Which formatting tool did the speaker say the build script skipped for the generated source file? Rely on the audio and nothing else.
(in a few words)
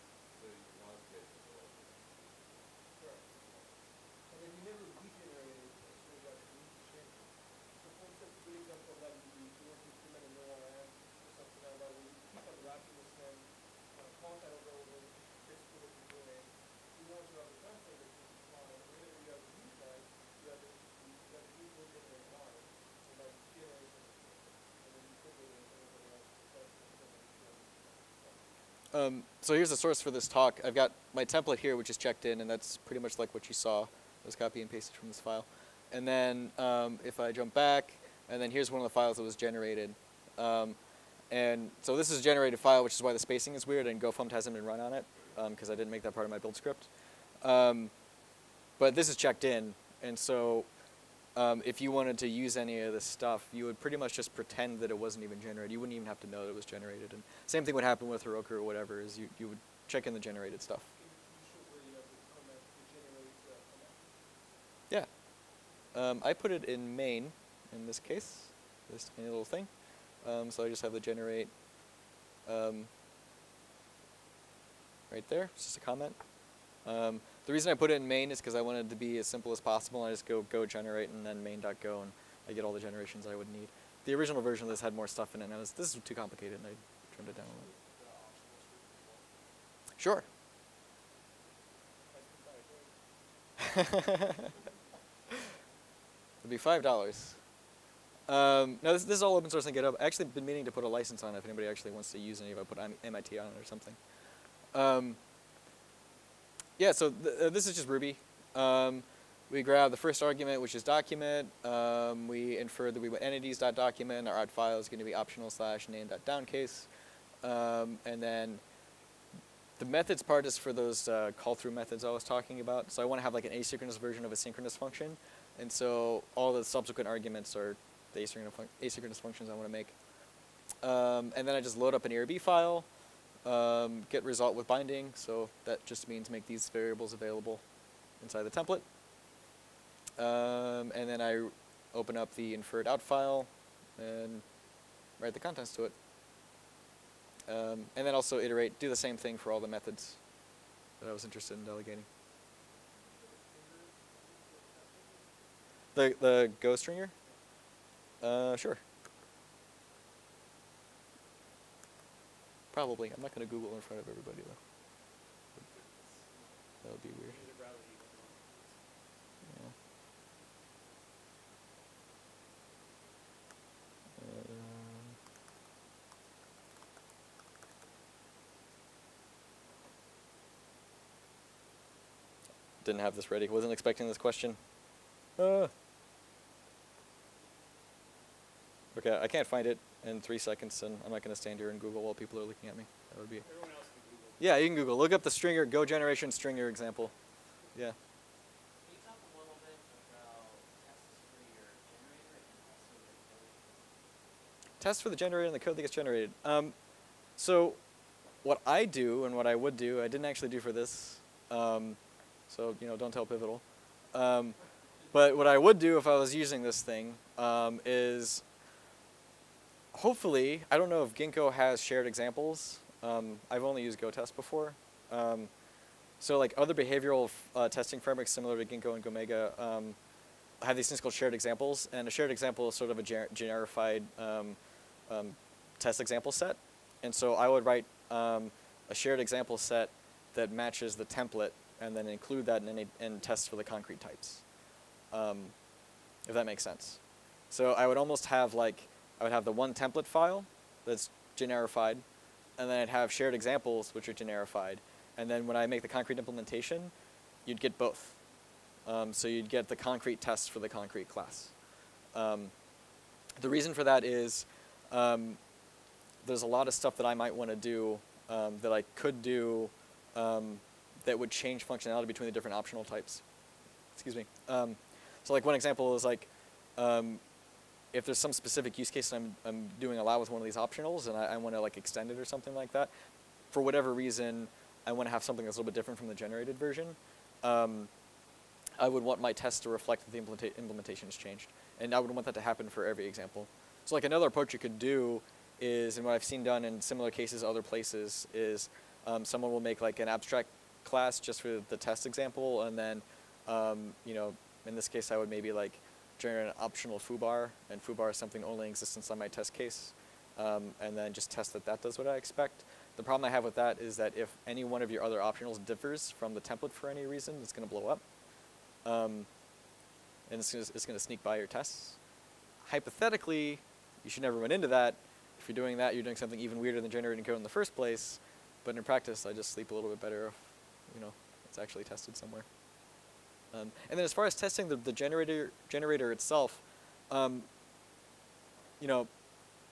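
gofmt.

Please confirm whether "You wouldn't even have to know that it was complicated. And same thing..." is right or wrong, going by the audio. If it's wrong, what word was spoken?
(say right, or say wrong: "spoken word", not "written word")
wrong: "generated", not "complicated".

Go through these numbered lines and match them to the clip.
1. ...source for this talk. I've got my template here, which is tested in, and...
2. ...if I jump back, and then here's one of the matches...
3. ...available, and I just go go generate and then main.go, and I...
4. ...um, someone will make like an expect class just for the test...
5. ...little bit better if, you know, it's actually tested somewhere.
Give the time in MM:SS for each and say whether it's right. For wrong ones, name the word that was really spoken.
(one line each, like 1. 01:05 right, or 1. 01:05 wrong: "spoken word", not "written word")
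1. 00:29 wrong: "checked", not "tested"
2. 00:37 wrong: "files", not "matches"
3. 01:19 wrong: "possible", not "available"
4. 04:59 wrong: "abstract", not "expect"
5. 05:29 right.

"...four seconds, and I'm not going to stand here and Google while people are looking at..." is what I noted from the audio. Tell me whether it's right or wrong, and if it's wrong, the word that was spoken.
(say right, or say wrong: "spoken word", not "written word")
wrong: "three", not "four".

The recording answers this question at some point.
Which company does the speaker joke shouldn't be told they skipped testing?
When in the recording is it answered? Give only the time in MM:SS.
03:33.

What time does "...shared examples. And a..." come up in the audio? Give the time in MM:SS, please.
03:51.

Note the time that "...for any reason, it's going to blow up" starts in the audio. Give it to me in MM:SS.
05:16.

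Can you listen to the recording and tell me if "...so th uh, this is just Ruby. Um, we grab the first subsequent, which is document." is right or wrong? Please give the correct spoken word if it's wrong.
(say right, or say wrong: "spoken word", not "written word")
wrong: "argument", not "subsequent".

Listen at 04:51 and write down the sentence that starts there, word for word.
And I would want that to happen for every example.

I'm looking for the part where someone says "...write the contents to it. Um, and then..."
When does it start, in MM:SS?
02:25.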